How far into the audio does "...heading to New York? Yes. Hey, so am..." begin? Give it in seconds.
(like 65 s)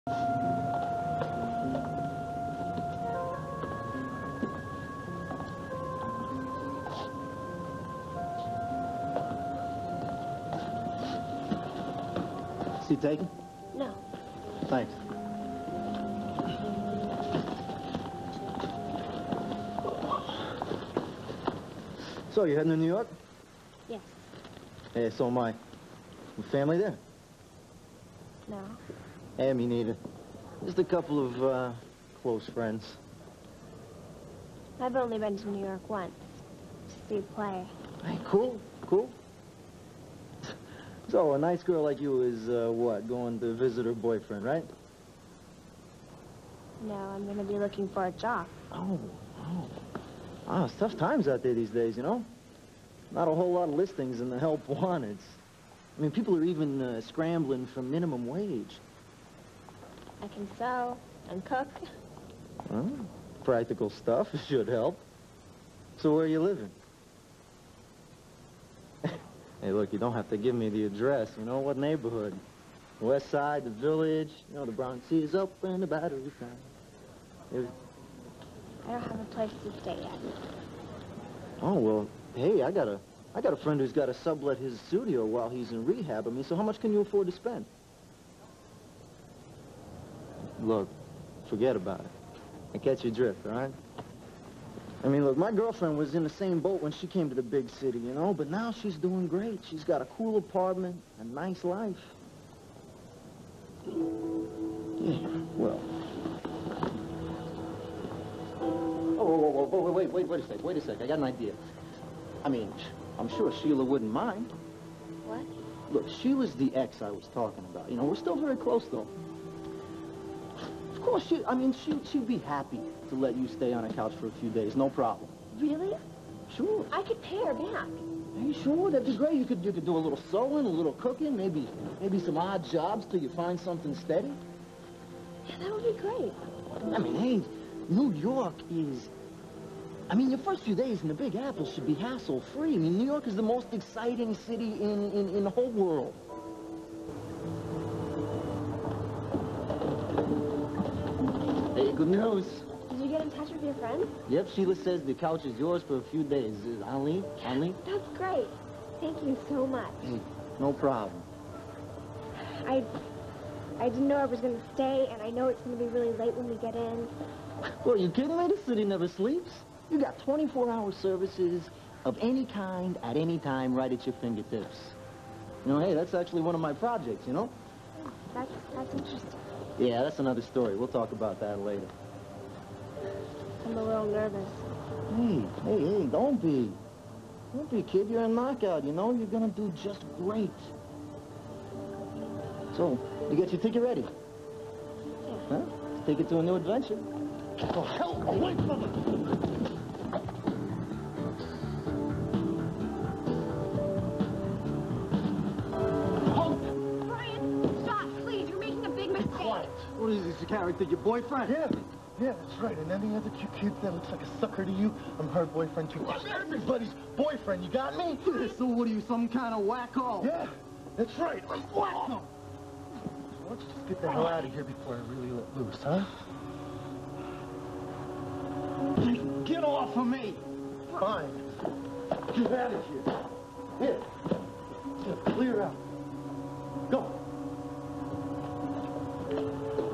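22 s.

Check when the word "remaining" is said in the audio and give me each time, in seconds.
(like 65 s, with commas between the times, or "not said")
not said.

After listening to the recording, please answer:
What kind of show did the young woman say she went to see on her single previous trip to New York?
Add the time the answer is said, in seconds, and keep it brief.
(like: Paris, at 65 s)
A play, at 37 s.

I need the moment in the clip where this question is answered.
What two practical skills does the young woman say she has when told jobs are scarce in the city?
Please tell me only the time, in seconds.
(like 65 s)
60 s.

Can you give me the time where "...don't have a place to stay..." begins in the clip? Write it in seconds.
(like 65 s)
78 s.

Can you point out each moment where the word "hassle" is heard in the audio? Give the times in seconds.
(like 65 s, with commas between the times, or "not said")
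141 s.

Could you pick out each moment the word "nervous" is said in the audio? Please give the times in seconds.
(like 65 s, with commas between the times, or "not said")
184 s.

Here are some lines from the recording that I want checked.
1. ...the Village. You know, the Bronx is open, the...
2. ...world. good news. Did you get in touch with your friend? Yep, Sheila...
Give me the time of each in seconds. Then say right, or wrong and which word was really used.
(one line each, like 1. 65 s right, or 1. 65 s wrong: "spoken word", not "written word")
1. 73 s right
2. 145 s right.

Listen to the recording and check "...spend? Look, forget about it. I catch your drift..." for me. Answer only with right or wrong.
right.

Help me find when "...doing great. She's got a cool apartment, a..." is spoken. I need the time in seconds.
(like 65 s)
98 s.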